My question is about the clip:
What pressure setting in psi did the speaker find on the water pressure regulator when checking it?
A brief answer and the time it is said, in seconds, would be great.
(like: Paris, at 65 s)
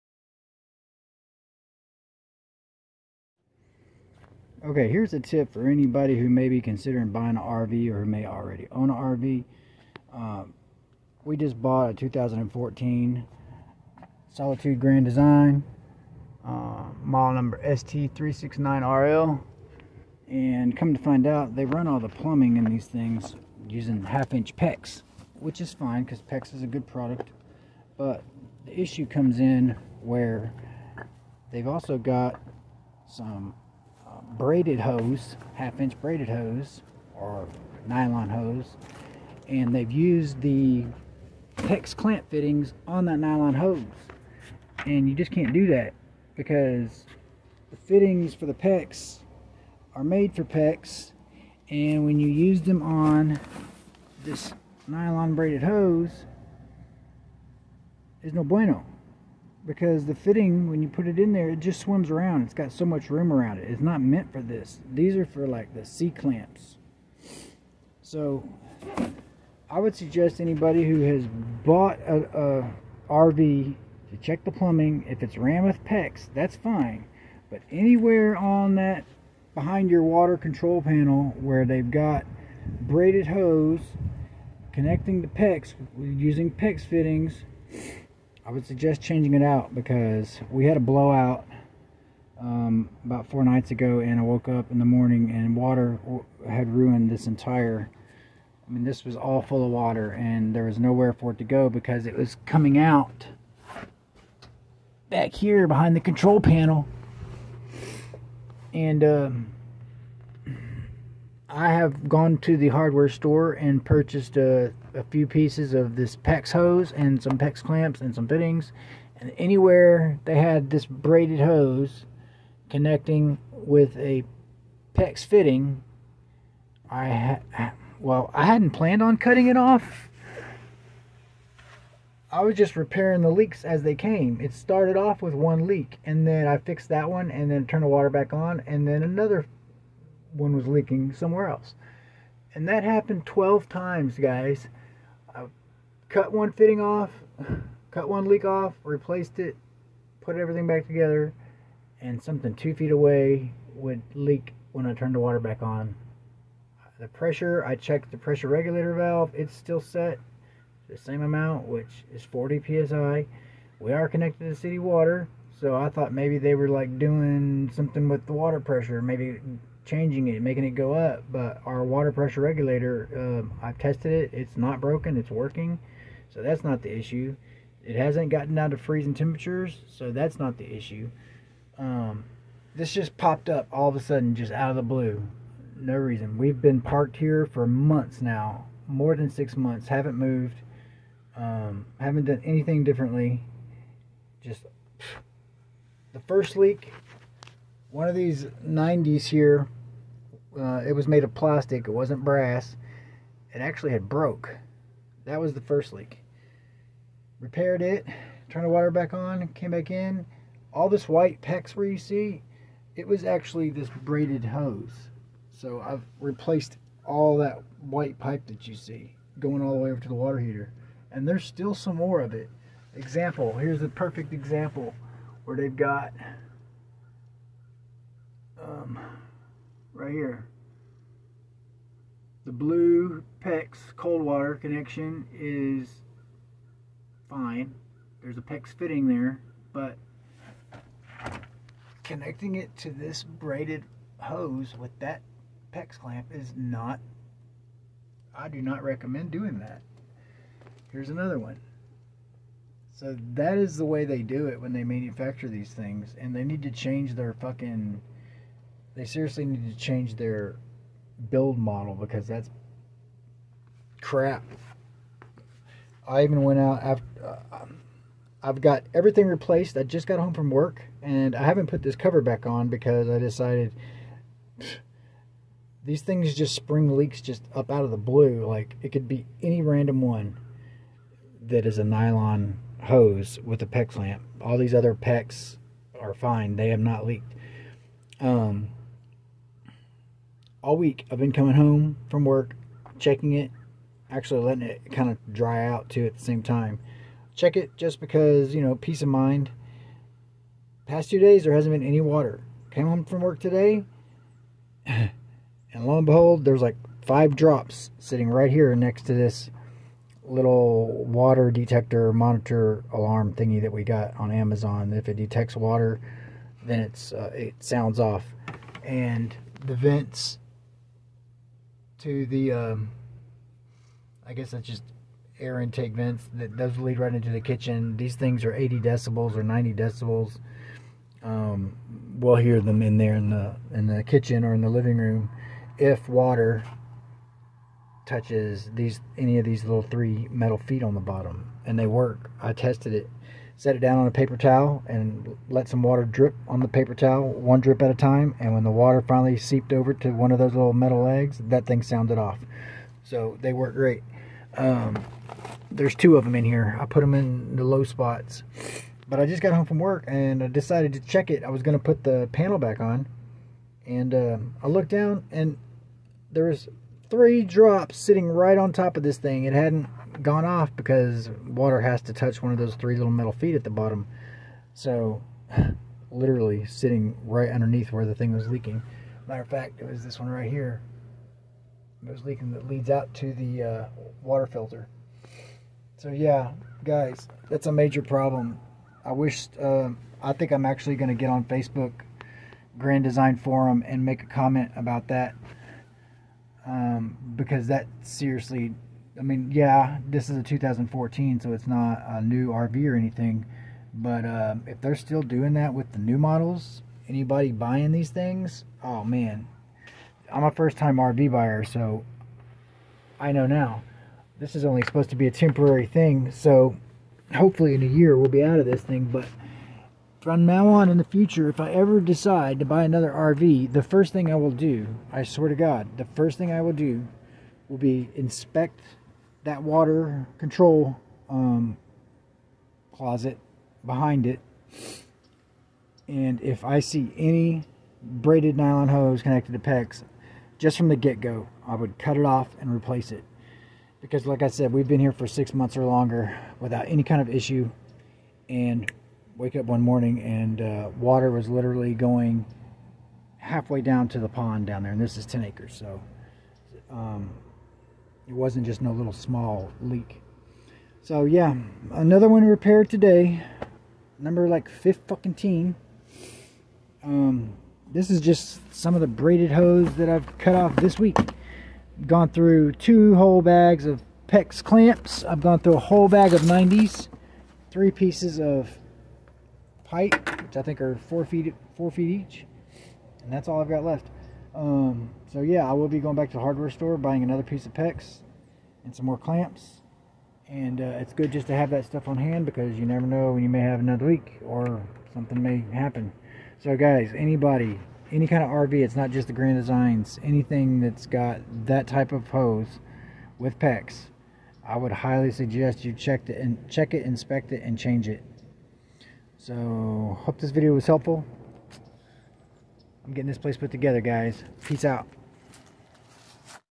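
40, at 162 s.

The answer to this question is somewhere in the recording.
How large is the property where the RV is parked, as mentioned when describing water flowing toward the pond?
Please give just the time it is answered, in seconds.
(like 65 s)
455 s.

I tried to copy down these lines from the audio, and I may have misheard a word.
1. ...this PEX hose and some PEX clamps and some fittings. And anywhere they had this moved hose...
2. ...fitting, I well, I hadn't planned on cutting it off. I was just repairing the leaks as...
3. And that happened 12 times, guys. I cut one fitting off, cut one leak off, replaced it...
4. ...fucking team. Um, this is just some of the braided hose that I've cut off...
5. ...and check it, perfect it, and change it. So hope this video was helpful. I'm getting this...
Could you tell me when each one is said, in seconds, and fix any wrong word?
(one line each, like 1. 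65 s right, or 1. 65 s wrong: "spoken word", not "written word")
1. 115 s wrong: "braided", not "moved"
2. 125 s right
3. 142 s right
4. 465 s right
5. 506 s wrong: "inspect", not "perfect".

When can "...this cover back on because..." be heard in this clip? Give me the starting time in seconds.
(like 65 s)
271 s.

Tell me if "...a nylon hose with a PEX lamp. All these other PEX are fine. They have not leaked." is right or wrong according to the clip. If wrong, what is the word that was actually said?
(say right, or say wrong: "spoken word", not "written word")
right.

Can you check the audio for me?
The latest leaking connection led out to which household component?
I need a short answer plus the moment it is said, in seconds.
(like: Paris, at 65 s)
water filter, at 384 s.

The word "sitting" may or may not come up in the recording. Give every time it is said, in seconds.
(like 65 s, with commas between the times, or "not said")
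307 s, 367 s, 376 s.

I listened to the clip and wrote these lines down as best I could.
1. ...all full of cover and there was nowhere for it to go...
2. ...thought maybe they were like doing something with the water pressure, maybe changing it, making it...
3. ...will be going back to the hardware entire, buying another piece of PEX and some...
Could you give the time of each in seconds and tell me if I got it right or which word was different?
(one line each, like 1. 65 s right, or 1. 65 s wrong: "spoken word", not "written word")
1. 99 s wrong: "water", not "cover"
2. 165 s right
3. 485 s wrong: "store", not "entire".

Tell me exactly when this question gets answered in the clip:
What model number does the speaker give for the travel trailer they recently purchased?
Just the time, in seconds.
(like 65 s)
17 s.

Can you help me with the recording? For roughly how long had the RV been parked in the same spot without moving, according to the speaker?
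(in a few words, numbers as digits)
more than six months.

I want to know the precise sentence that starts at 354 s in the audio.
Um, there's two of them in here.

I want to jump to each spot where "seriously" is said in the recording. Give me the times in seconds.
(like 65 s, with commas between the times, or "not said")
259 s, 398 s.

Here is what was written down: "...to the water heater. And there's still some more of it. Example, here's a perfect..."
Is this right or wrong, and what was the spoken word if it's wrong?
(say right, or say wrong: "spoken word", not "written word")
right.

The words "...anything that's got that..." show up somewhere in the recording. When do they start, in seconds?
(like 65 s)
500 s.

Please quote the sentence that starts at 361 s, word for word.
I was going to put the panel back on.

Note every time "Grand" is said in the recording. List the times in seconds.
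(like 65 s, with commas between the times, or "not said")
14 s, 392 s, 499 s.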